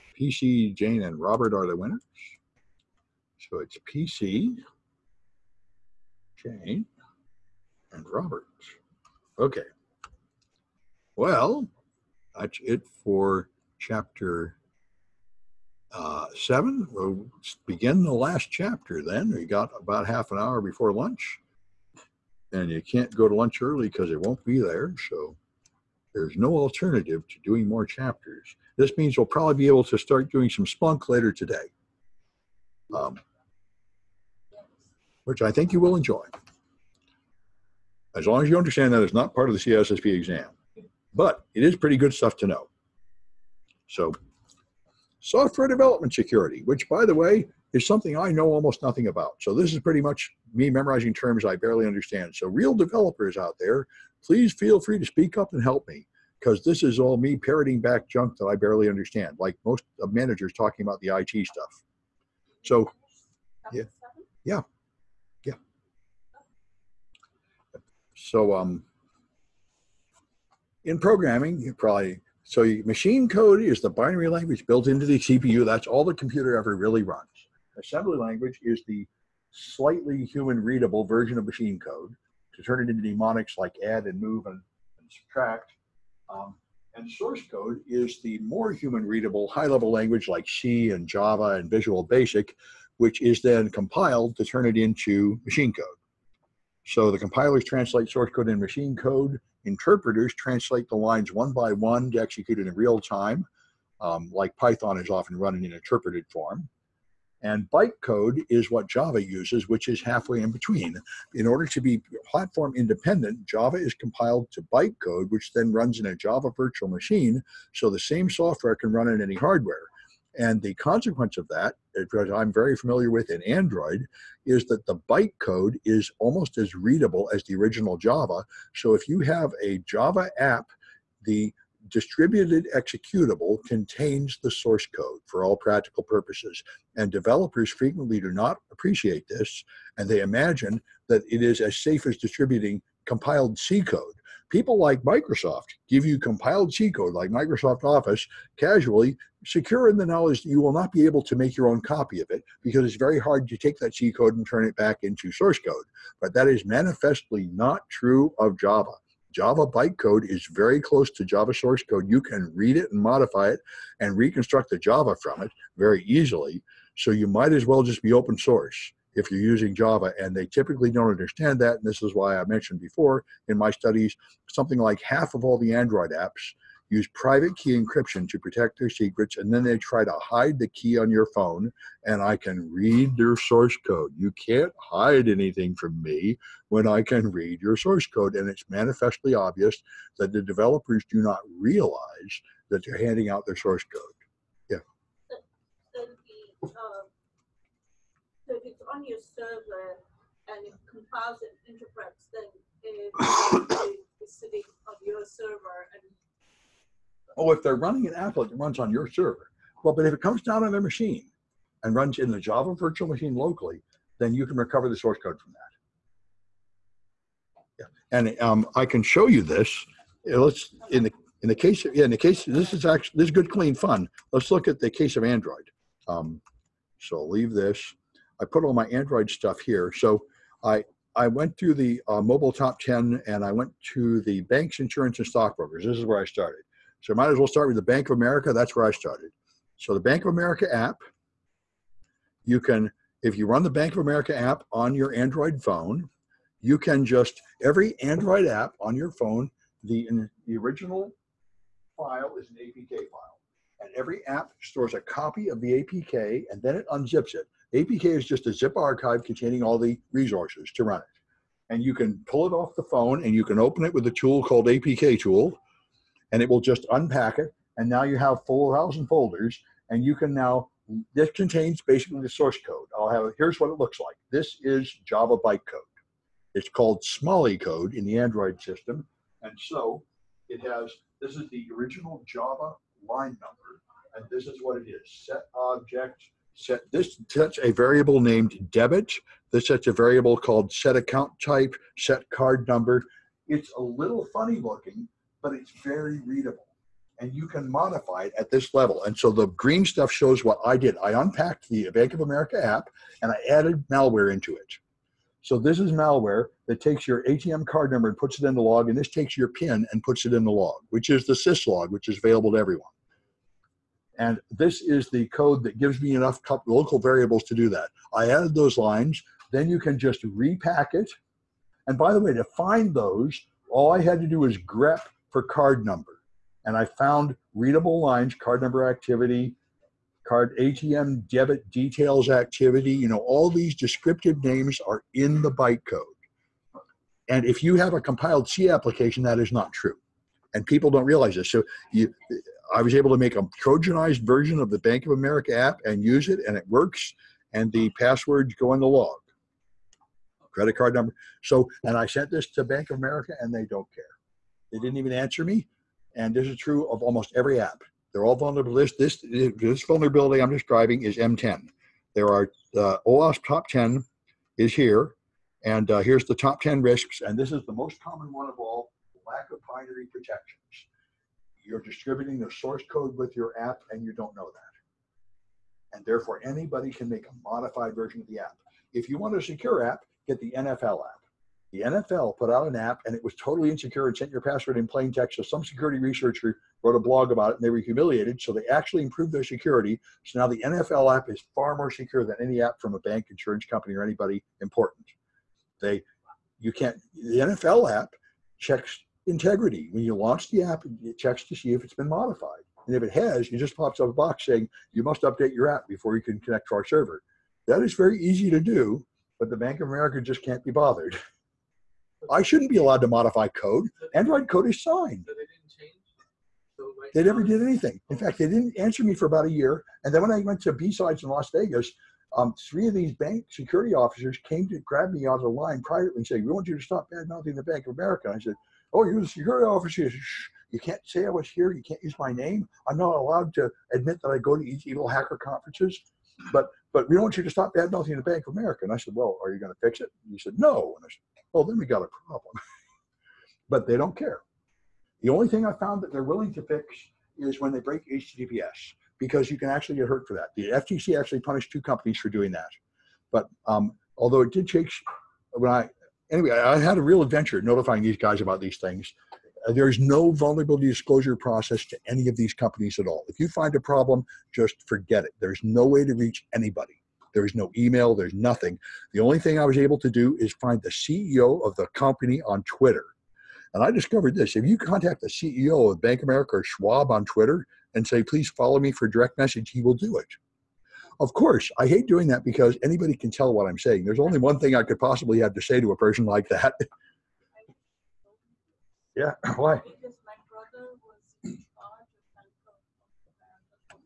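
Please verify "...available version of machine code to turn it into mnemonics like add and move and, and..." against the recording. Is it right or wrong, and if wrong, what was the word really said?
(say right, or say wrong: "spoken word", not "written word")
wrong: "readable", not "available".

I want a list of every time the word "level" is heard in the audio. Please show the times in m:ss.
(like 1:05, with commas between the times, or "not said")
1:29, 4:58.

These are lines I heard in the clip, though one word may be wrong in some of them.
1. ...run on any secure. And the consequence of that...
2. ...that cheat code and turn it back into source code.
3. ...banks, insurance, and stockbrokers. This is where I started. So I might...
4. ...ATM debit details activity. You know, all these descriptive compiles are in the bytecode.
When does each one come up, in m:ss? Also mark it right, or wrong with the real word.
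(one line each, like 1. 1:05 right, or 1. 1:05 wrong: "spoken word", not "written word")
1. 1:58 wrong: "hardware", not "secure"
2. 2:33 right
3. 3:54 right
4. 5:30 wrong: "names", not "compiles".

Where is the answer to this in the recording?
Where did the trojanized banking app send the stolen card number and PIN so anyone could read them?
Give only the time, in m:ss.
5:11.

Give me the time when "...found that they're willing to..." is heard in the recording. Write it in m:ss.
7:25.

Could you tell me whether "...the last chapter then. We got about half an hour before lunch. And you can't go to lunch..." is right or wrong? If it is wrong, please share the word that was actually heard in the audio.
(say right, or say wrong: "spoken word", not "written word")
right.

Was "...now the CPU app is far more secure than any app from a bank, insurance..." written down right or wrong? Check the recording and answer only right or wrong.
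wrong.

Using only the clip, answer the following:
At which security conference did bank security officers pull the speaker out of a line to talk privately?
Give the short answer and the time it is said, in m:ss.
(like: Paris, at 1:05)
B-Sides, at 7:00.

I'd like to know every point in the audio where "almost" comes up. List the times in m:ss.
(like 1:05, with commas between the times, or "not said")
0:48, 2:06, 5:57.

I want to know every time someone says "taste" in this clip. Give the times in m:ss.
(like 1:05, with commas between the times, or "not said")
not said.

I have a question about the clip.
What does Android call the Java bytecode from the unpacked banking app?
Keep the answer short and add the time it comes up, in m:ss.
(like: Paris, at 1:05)
Smali code, at 4:37.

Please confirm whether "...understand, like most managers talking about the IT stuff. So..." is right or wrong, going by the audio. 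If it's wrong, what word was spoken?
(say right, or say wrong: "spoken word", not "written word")
right.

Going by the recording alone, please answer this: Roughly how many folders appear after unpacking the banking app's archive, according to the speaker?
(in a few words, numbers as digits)
4,000.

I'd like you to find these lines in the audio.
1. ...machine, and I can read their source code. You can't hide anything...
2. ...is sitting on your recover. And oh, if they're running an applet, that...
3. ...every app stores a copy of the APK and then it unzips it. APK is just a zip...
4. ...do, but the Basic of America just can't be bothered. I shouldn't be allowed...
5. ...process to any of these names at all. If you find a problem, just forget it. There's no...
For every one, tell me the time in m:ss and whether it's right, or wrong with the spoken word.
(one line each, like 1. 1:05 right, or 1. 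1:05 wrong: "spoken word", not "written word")
1. 3:01 wrong: "phone", not "machine"
2. 3:24 wrong: "server", not "recover"
3. 4:13 right
4. 6:48 wrong: "Bank", not "Basic"
5. 7:41 wrong: "companies", not "names".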